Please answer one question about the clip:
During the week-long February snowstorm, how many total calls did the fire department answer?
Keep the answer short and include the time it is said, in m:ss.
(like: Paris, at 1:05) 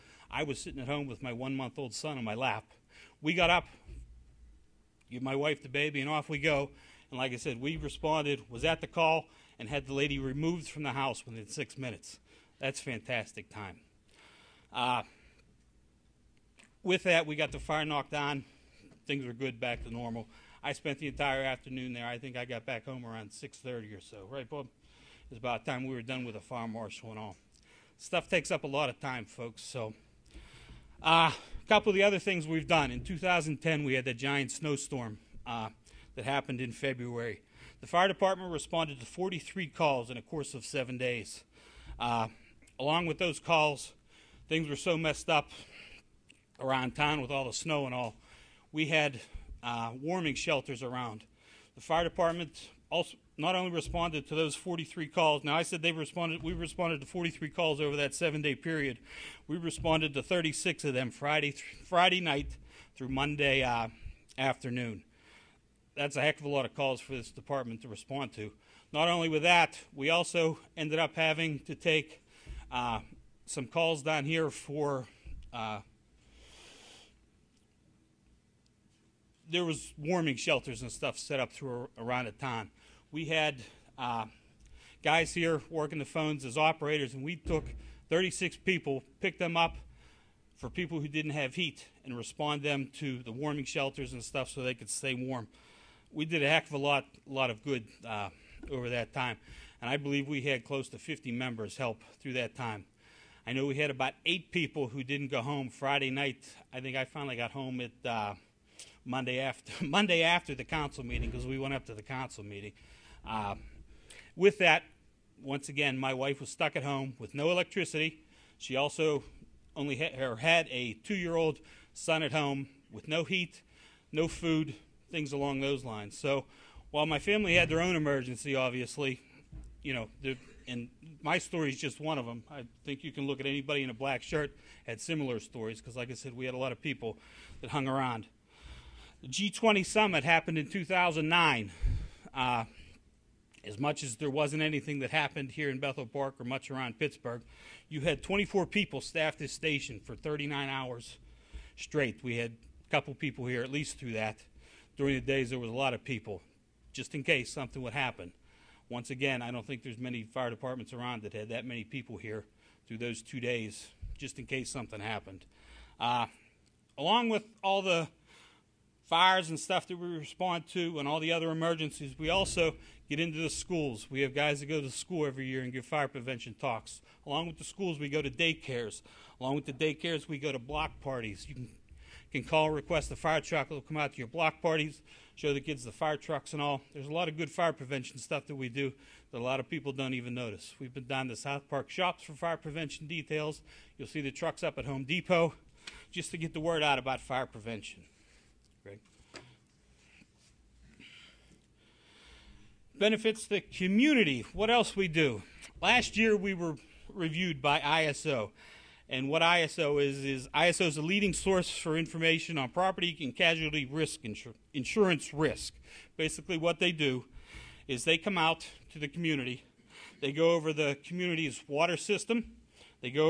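43, at 0:39.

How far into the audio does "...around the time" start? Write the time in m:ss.
1:21.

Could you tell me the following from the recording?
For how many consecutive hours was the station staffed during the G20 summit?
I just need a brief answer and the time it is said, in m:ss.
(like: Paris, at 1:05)
39, at 2:30.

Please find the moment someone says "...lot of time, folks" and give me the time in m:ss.
0:28.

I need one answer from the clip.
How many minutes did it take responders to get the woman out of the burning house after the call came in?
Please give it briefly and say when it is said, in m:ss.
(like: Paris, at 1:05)
6, at 0:11.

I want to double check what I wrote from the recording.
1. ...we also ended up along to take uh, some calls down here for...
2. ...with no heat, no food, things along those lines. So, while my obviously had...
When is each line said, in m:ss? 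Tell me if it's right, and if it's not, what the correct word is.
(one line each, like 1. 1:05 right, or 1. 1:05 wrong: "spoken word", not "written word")
1. 1:09 wrong: "having", not "along"
2. 2:02 wrong: "family", not "obviously".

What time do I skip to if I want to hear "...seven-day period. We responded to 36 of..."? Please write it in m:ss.
0:58.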